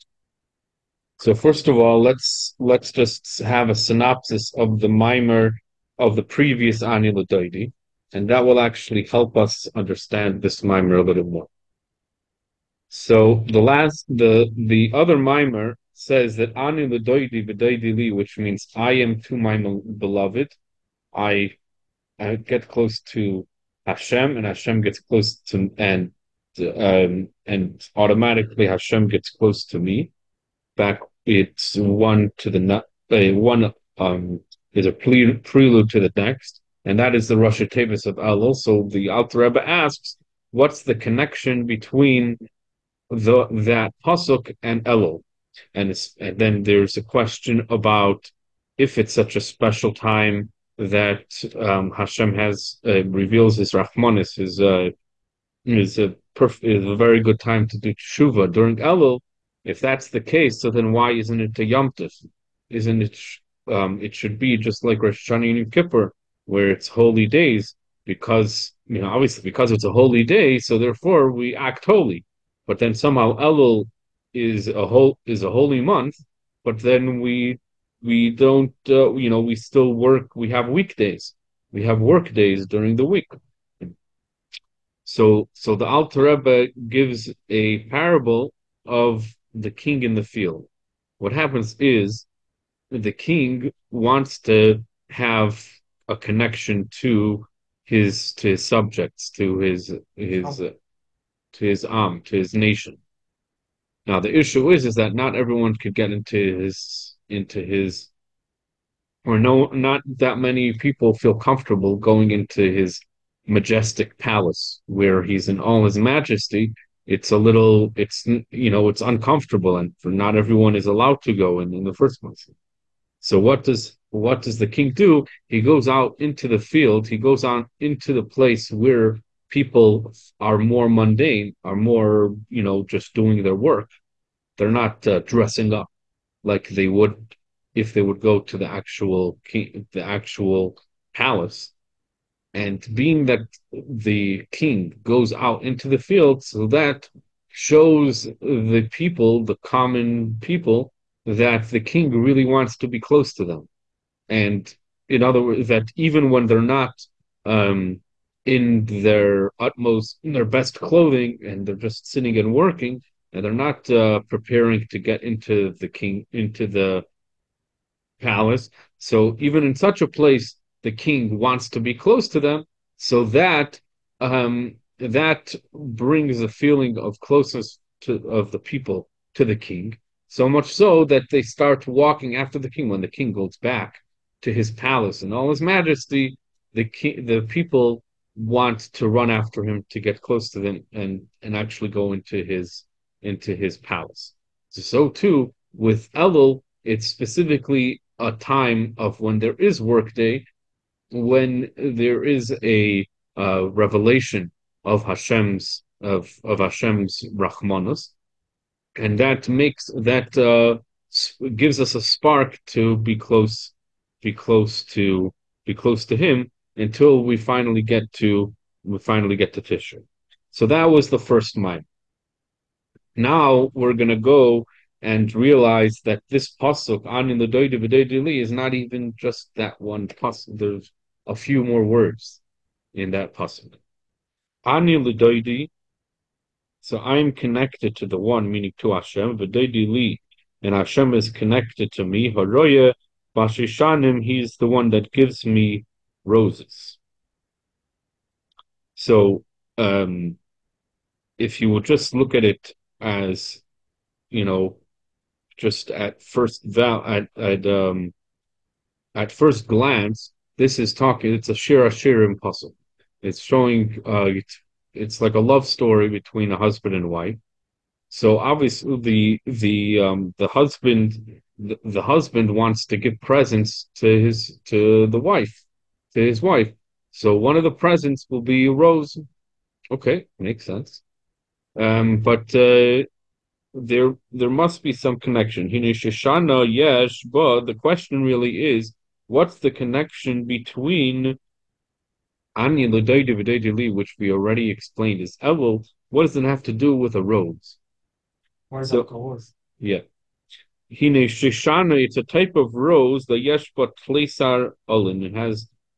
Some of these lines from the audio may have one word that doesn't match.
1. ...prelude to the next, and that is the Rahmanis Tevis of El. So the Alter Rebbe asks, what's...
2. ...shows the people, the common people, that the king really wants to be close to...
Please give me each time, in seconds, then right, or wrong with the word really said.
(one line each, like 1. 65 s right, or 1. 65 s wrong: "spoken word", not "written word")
1. 35 s wrong: "Rosh", not "Rahmanis"
2. 147 s right.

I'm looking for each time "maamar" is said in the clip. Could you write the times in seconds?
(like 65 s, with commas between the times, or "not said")
4 s, 10 s, 15 s.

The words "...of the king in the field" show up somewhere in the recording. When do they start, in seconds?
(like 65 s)
88 s.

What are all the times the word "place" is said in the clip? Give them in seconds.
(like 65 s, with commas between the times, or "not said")
122 s, 128 s, 170 s.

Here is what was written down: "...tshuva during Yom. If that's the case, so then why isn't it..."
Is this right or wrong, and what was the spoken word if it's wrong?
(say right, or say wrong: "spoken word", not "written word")
wrong: "Elul", not "Yom".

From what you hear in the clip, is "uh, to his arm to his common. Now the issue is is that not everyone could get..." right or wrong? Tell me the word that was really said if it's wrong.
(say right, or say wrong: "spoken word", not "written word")
wrong: "nation", not "common".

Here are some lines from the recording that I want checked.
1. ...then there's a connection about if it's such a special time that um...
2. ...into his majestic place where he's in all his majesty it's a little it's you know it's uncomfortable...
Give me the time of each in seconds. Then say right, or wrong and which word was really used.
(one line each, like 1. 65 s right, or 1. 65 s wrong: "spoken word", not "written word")
1. 46 s wrong: "question", not "connection"
2. 112 s wrong: "palace", not "place".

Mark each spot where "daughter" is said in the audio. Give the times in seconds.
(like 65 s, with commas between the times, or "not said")
not said.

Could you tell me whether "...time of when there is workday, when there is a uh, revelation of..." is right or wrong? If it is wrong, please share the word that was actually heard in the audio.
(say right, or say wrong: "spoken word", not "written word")
right.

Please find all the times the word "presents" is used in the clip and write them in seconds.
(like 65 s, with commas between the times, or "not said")
273 s, 277 s.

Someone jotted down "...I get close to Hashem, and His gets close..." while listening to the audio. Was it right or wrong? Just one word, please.
wrong.